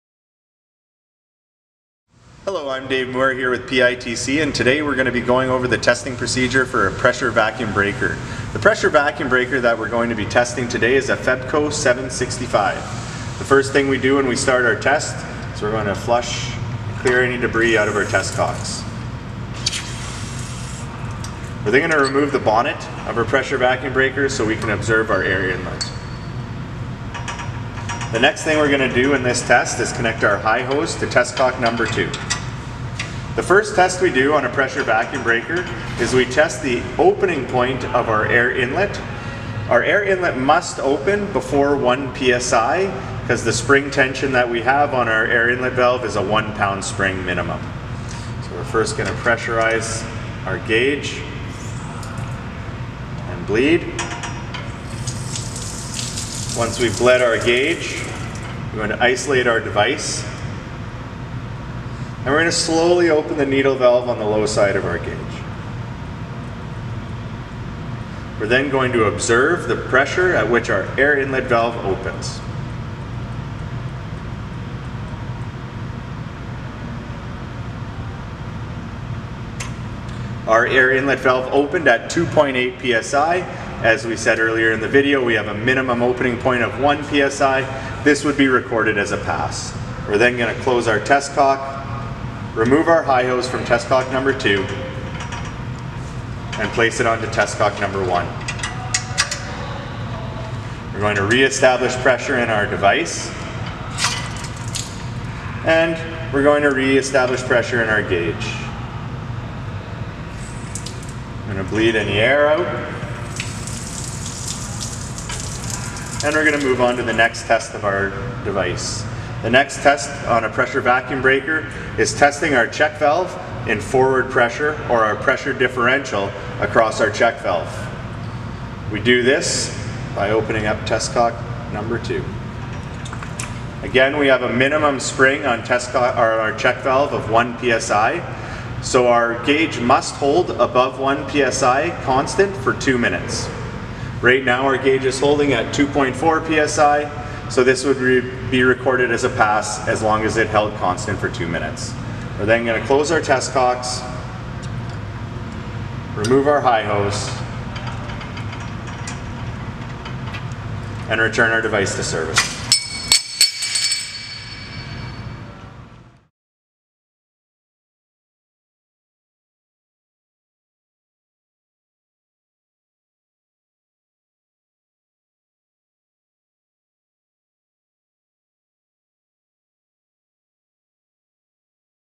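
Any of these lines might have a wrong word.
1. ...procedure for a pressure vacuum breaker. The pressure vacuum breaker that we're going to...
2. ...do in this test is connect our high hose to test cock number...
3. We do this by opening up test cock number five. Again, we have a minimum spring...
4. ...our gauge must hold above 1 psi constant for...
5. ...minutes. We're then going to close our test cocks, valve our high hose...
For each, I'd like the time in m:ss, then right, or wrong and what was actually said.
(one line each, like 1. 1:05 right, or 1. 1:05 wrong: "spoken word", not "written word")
1. 0:06 right
2. 0:28 right
3. 2:08 wrong: "two", not "five"
4. 2:19 right
5. 2:31 wrong: "remove", not "valve".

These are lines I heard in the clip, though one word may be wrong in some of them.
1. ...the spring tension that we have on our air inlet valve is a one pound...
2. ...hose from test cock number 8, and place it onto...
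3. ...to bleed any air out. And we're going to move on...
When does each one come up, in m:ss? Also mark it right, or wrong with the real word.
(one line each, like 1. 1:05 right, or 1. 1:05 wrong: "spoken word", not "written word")
1. 0:43 right
2. 1:33 wrong: "2", not "8"
3. 1:51 right.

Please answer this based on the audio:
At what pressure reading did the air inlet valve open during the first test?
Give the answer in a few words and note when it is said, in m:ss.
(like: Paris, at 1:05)
2.8 psi, at 1:22.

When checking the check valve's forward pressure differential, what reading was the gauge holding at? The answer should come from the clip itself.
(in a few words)
2.4 psi.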